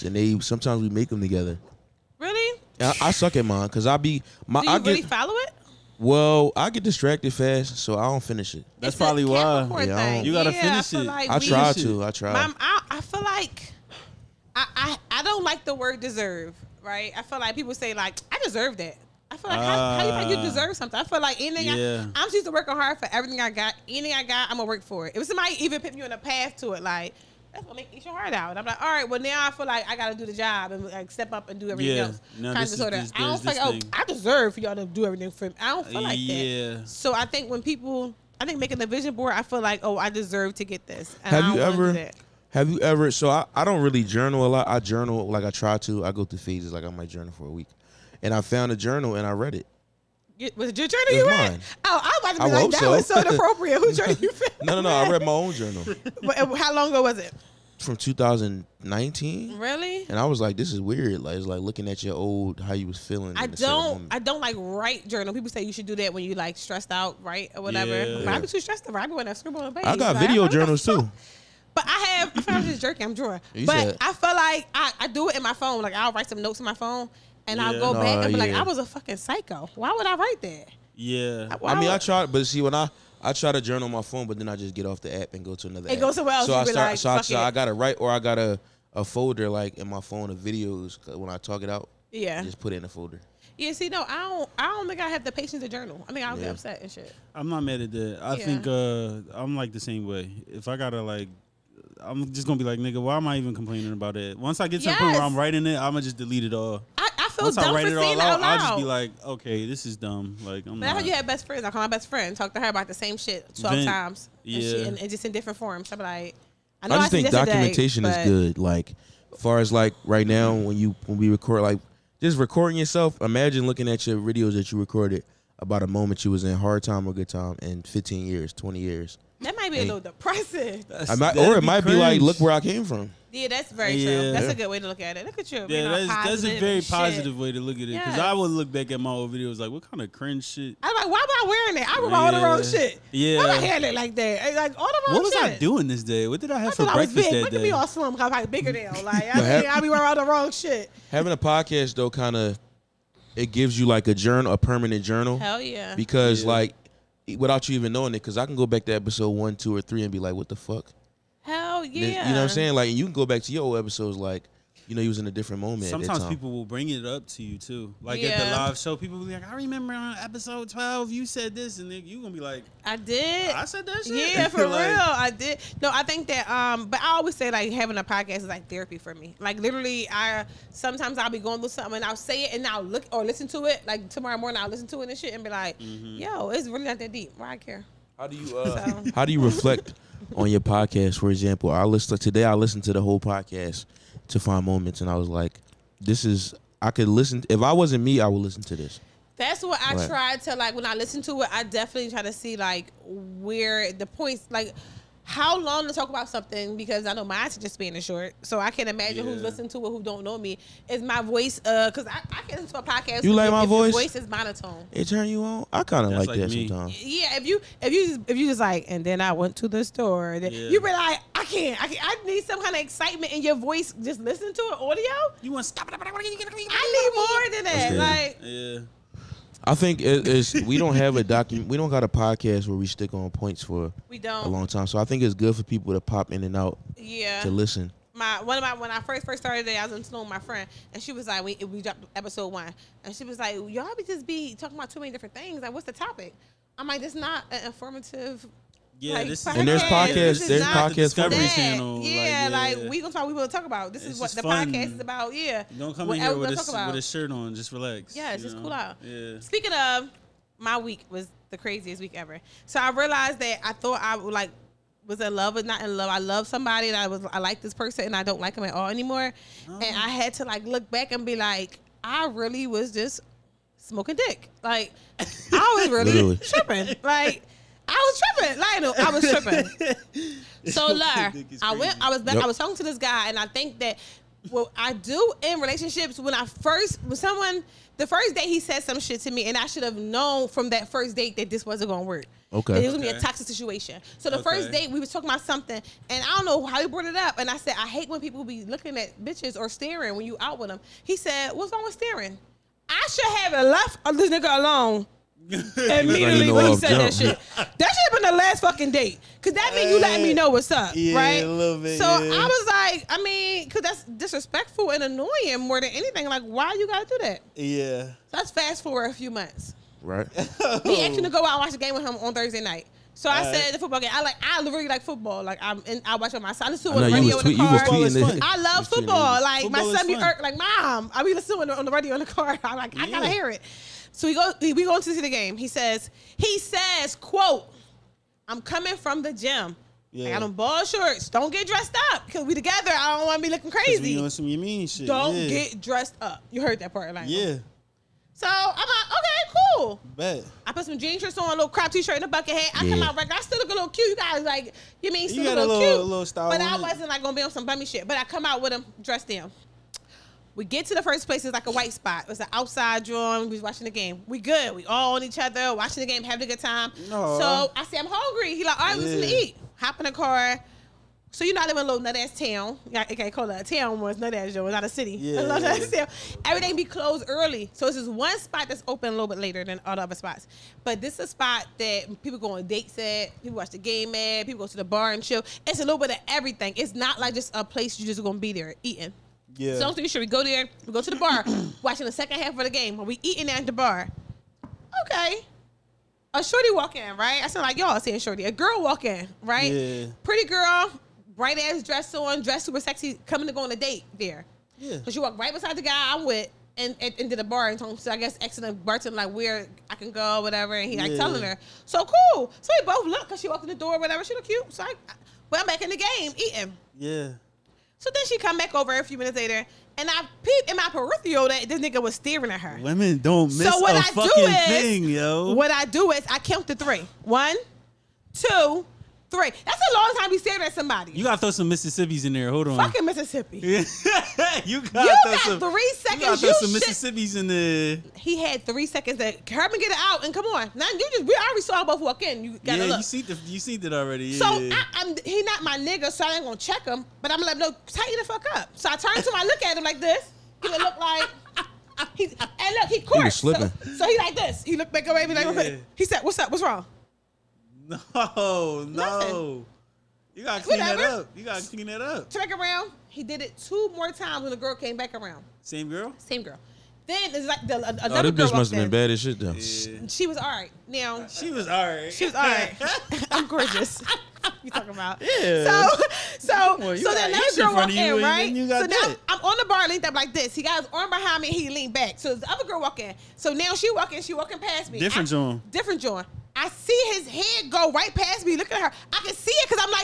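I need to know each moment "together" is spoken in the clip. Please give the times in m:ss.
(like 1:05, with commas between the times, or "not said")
0:01, 5:42.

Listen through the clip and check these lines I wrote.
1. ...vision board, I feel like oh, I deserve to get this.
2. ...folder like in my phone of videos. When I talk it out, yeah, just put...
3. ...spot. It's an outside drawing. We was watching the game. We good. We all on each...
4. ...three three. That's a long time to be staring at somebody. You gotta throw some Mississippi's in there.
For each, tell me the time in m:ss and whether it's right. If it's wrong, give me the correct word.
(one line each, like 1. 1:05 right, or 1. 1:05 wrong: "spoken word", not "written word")
1. 0:38 right
2. 1:29 right
3. 6:01 right
4. 7:06 right.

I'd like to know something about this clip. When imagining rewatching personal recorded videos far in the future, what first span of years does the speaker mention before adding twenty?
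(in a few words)
15 years.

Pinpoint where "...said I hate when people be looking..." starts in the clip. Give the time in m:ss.
4:57.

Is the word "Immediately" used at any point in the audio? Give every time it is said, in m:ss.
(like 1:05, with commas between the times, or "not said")
5:05.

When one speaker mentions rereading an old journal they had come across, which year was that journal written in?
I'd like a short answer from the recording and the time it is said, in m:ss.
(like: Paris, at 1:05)
2019, at 0:57.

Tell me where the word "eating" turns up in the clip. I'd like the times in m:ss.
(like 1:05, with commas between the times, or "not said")
6:28, 6:33, 6:56.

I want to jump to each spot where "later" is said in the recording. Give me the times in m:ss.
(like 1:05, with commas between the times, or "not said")
6:19, 6:59.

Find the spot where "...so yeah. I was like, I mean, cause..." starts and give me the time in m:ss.
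5:11.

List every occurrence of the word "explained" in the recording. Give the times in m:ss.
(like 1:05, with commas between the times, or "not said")
not said.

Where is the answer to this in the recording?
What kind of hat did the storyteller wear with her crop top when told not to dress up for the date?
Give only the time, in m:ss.
5:52.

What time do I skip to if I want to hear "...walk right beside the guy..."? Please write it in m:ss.
6:45.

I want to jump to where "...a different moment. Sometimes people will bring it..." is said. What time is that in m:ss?
2:45.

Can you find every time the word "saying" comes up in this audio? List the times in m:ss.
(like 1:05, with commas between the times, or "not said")
1:48, 2:42, 6:37.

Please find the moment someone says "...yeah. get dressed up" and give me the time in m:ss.
5:45.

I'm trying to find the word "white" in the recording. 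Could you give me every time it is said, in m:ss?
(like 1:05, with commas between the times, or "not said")
6:01.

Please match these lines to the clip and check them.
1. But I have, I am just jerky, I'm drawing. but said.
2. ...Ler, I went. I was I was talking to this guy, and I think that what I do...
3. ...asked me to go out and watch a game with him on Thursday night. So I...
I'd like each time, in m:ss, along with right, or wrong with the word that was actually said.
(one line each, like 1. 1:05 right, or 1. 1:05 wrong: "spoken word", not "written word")
1. 1:11 right
2. 4:40 right
3. 5:21 right.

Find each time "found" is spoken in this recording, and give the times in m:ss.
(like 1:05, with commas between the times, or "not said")
0:48, 0:54.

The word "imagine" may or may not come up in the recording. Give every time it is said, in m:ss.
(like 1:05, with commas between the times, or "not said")
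2:03, 3:28.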